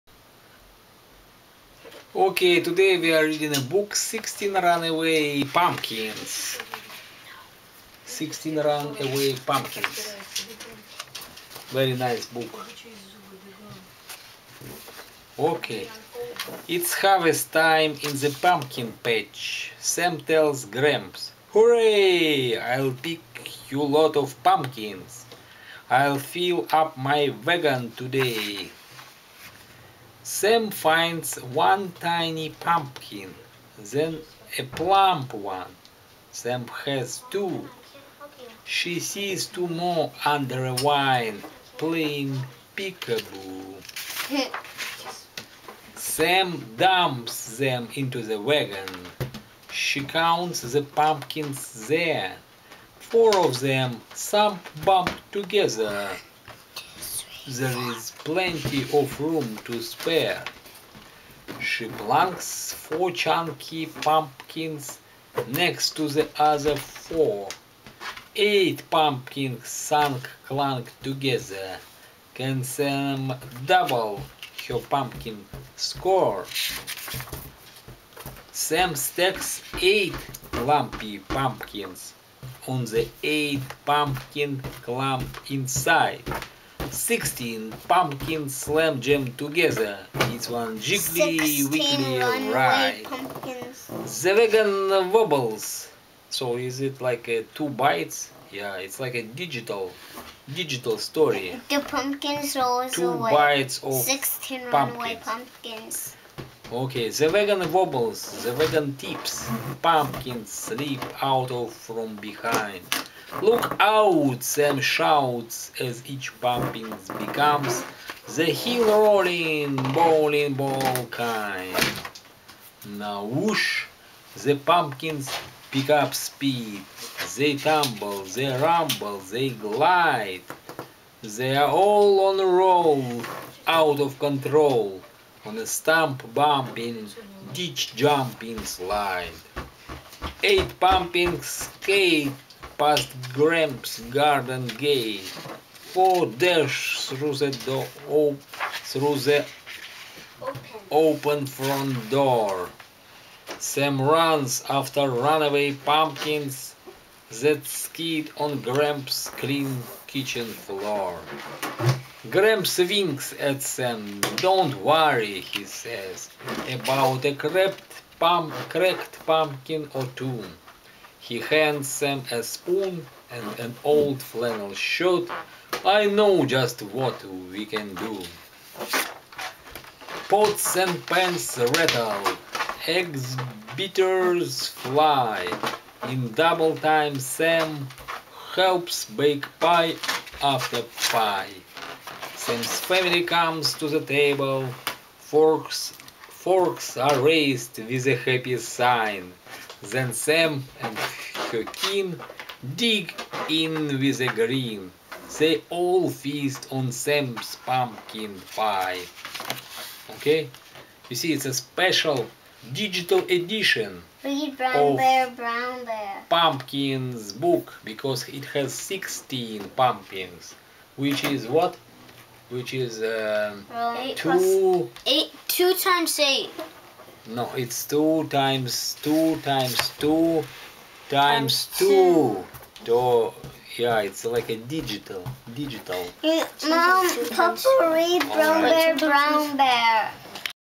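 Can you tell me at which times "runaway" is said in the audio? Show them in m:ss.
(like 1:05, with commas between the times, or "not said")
0:04, 0:08, 2:35.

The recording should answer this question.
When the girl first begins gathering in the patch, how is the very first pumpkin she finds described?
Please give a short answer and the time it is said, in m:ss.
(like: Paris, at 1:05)
tiny, at 0:31.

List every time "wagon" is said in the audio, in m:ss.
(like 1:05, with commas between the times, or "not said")
0:27, 0:48.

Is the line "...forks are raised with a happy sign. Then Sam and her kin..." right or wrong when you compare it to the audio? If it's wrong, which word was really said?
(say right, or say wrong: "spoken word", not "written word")
right.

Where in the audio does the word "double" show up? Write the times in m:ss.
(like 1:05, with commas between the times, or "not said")
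1:13, 3:06.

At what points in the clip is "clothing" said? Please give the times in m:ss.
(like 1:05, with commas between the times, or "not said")
not said.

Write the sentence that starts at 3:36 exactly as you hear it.
Pumpkins book because it has 16 pumpkins, which is what?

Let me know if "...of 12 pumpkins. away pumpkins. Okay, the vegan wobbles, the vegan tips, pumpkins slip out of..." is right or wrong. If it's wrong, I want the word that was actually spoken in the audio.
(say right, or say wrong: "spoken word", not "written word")
wrong: "16", not "12".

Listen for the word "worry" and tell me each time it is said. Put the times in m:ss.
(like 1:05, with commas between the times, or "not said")
2:44.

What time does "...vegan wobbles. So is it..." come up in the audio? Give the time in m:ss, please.
1:34.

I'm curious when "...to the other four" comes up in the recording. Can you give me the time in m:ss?
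1:05.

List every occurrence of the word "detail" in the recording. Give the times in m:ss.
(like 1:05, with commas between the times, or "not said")
not said.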